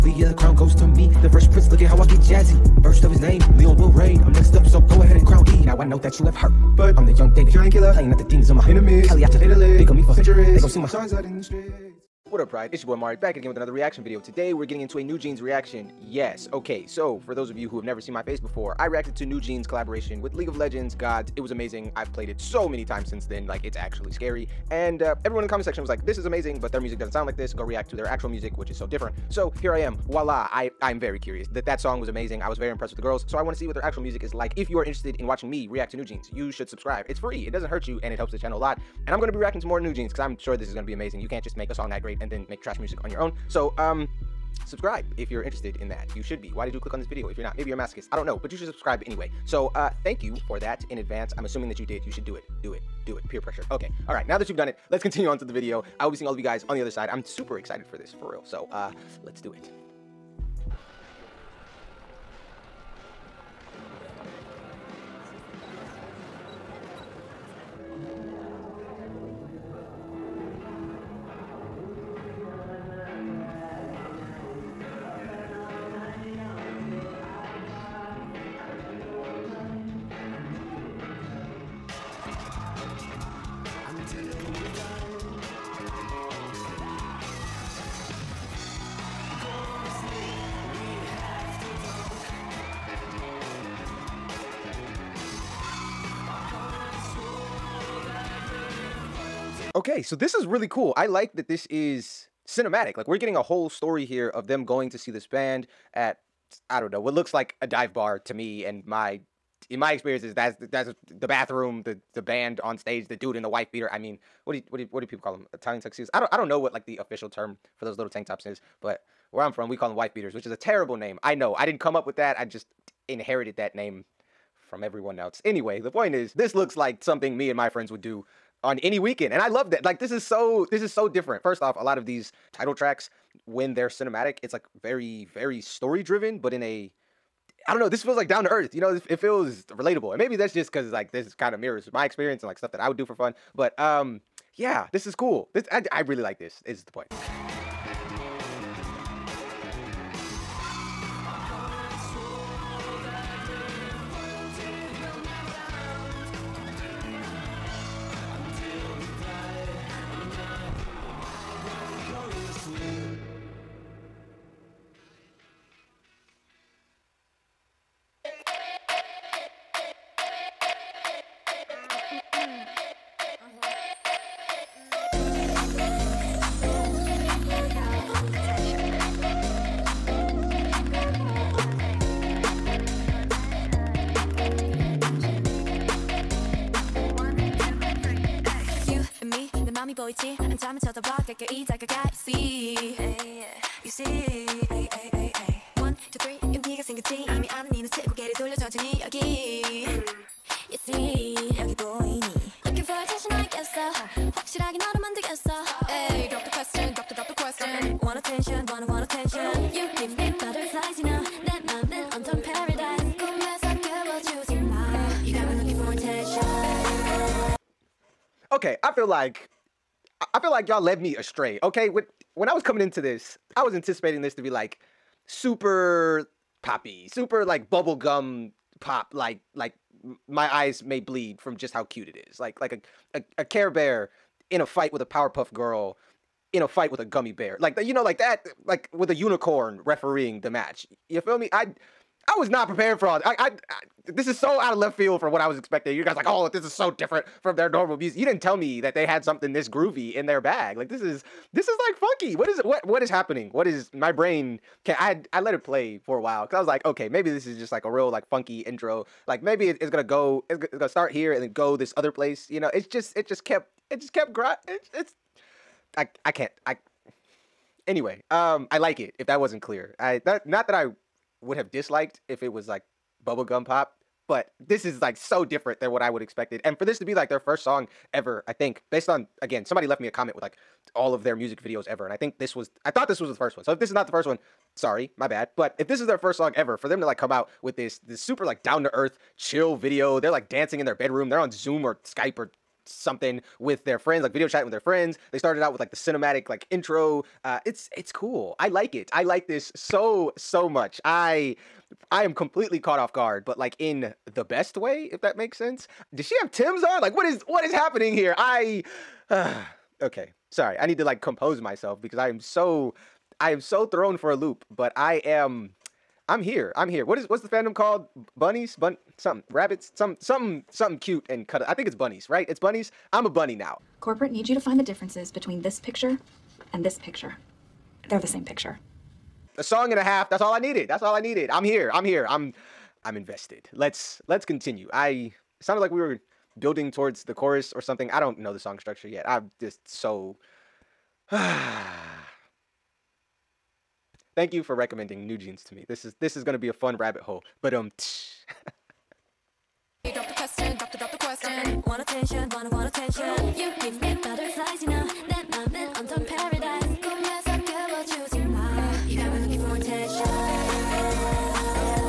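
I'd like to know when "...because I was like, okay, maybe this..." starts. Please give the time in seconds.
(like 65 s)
256 s.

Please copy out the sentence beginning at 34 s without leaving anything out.
If you you are interested in watching me react to new jeans, you should subscribe.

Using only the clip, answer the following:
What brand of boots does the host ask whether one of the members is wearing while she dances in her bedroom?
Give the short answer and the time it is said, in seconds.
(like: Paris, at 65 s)
Timbs, at 306 s.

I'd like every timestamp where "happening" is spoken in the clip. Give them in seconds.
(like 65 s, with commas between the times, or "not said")
253 s, 307 s.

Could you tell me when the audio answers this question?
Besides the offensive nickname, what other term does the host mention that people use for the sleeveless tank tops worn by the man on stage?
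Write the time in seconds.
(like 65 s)
115 s.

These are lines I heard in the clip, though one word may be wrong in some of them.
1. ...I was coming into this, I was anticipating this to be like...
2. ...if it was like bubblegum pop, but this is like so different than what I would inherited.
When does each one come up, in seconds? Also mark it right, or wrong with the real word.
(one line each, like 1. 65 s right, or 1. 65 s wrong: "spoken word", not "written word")
1. 222 s right
2. 272 s wrong: "expected", not "inherited".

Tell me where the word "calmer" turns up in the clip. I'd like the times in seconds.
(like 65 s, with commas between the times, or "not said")
not said.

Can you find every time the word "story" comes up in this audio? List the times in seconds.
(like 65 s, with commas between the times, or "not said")
103 s, 135 s.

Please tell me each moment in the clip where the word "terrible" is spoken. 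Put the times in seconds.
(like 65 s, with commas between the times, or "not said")
120 s.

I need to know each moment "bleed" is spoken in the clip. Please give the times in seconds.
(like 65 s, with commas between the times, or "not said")
230 s.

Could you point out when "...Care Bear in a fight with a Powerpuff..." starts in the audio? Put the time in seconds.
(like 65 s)
233 s.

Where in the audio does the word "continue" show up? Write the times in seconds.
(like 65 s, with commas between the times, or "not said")
55 s, 334 s.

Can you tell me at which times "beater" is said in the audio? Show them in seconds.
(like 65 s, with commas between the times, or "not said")
113 s, 120 s.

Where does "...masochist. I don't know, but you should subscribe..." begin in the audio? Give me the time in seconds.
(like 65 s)
47 s.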